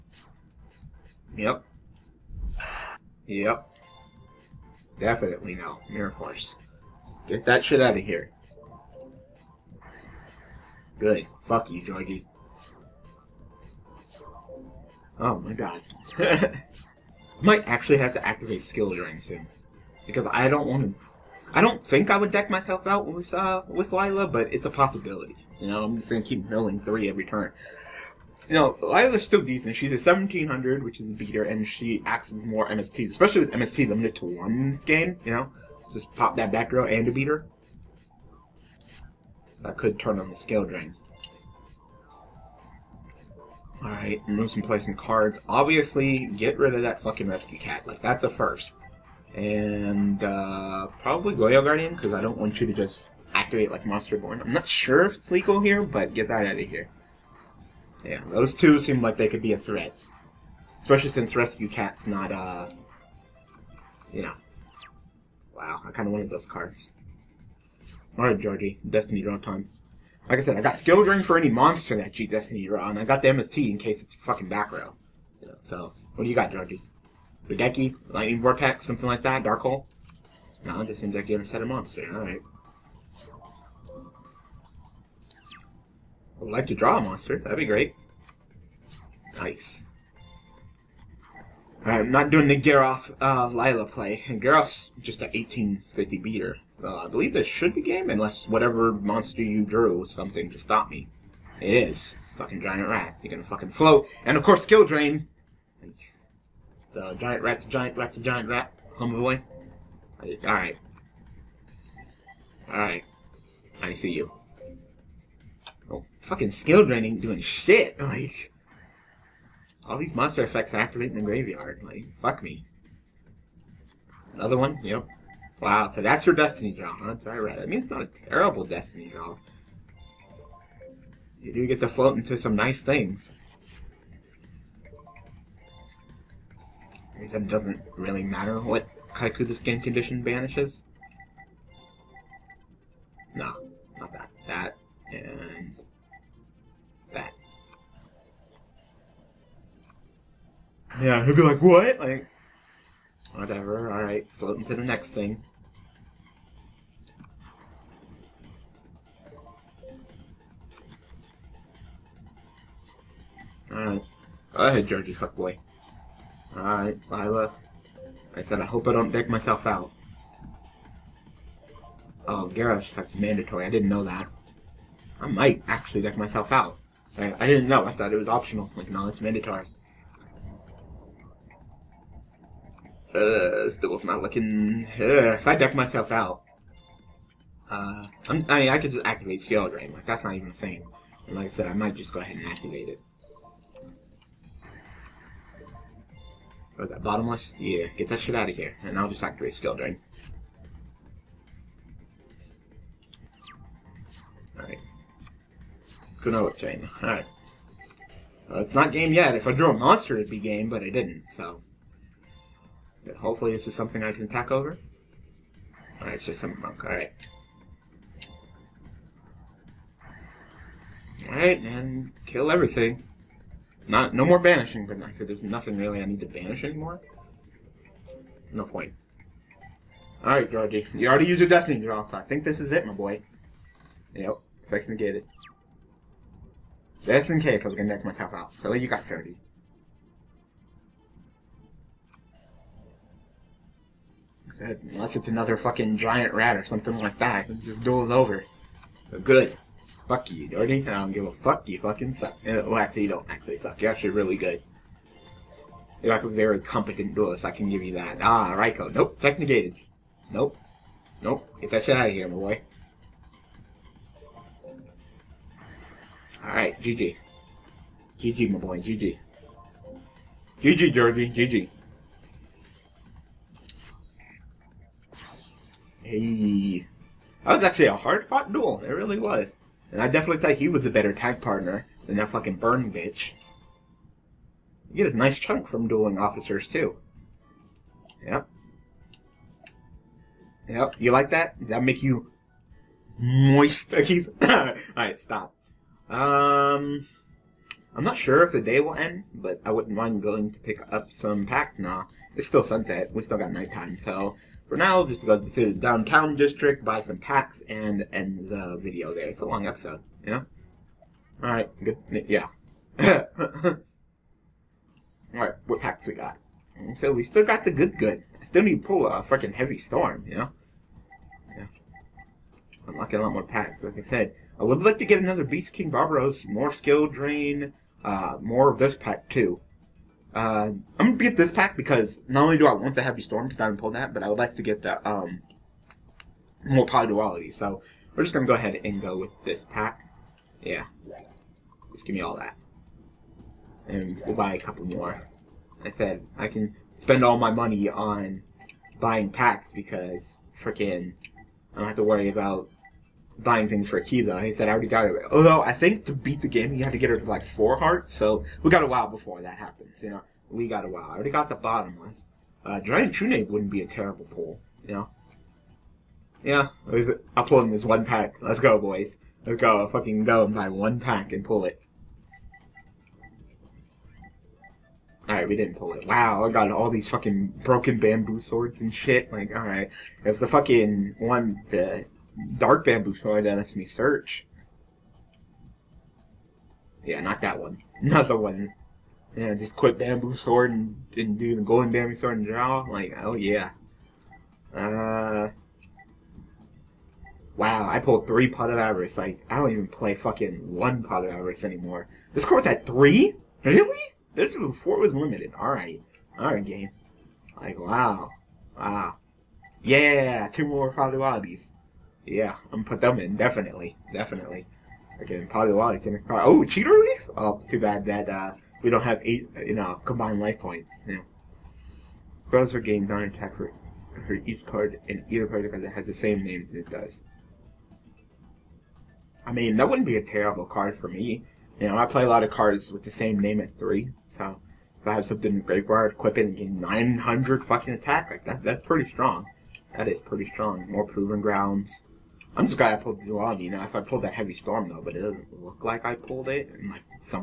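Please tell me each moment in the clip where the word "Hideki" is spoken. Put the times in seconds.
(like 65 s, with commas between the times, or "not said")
77 s.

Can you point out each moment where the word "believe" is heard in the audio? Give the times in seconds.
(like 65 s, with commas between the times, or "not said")
97 s.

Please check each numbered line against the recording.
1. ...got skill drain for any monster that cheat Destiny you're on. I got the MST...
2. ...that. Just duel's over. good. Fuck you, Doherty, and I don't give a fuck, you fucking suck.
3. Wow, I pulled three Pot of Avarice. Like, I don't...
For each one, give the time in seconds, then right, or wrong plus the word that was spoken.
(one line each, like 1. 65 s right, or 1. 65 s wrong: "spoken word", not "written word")
1. 70 s right
2. 247 s right
3. 397 s right.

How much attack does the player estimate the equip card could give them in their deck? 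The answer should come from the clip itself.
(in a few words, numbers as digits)
900.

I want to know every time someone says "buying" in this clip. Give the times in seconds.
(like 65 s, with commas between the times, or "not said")
348 s, 353 s.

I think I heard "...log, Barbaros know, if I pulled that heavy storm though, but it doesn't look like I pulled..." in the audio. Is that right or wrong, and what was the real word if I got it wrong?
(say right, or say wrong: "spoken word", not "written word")
wrong: "You", not "Barbaros".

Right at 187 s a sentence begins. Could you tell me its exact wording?
Uh, I'm, I mean, I could just activate Skill Drain.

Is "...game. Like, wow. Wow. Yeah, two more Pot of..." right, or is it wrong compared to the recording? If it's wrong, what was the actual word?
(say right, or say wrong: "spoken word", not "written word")
right.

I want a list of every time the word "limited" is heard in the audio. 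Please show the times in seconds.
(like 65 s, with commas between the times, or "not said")
33 s, 405 s.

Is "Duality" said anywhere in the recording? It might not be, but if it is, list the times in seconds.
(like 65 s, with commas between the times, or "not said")
337 s.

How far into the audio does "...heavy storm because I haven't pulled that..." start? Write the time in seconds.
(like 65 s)
333 s.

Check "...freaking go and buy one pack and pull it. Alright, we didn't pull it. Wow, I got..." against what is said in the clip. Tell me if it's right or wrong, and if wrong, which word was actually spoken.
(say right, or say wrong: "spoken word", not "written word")
wrong: "fucking", not "freaking".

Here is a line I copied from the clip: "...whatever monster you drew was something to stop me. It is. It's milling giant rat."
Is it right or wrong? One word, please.
wrong.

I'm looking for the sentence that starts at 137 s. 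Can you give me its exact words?
He said it doesn't really matter what Kaiku the skin condition banishes.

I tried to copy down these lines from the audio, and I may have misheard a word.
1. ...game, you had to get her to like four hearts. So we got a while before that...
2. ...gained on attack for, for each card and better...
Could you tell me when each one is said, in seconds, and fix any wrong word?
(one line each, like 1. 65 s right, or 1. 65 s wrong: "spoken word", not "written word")
1. 356 s right
2. 422 s wrong: "either", not "better".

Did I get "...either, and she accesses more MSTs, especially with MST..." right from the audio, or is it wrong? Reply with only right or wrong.
wrong.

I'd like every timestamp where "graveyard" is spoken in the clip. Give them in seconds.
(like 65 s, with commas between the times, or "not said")
121 s, 435 s.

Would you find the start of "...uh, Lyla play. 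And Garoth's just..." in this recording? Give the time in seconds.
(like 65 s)
93 s.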